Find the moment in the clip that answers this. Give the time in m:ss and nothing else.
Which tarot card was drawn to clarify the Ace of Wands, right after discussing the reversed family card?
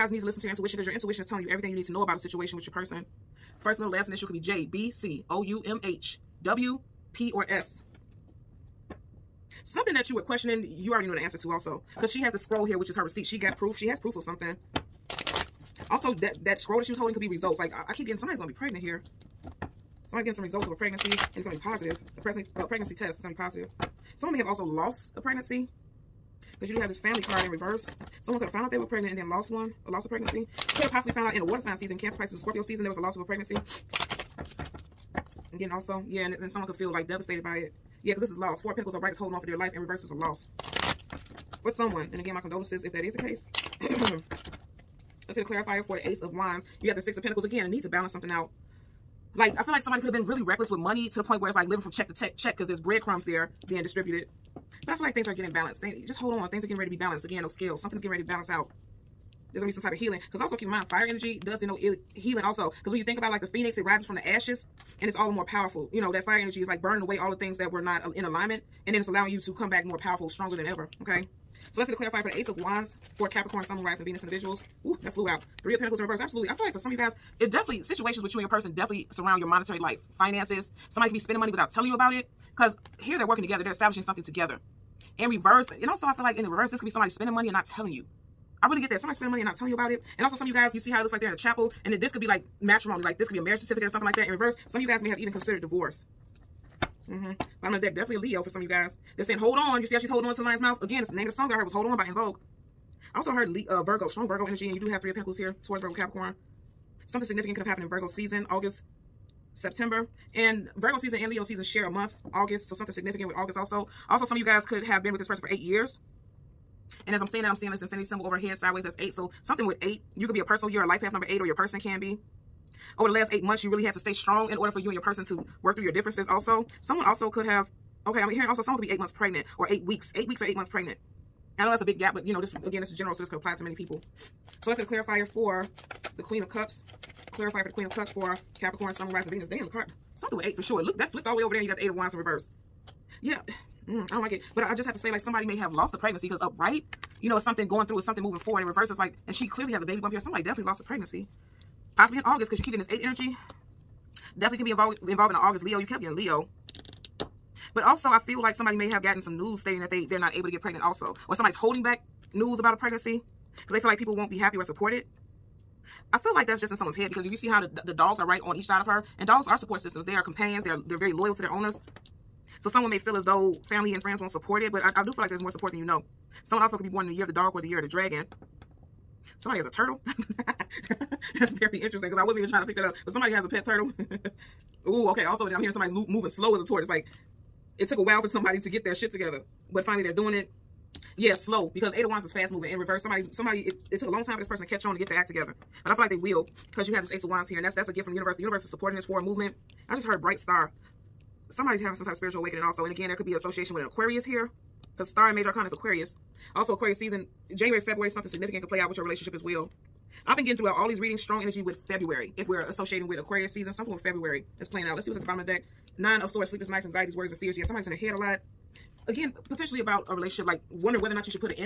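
0:47.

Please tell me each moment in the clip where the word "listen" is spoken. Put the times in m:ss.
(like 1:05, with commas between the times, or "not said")
0:00.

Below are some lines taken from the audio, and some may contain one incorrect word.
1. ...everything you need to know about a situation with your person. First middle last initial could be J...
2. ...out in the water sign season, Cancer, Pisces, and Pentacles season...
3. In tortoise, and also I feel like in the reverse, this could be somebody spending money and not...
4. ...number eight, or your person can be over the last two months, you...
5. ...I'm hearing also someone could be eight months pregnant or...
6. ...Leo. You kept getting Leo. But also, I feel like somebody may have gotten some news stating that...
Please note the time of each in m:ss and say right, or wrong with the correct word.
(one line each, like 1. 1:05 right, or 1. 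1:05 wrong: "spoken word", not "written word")
1. 0:01 right
2. 0:31 wrong: "Scorpio", not "Pentacles"
3. 1:25 wrong: "reverse", not "tortoise"
4. 2:01 wrong: "eight", not "two"
5. 2:08 right
6. 2:35 right.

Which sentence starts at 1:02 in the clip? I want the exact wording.
Because when you think about it, like the phoenix, it rises from the ashes.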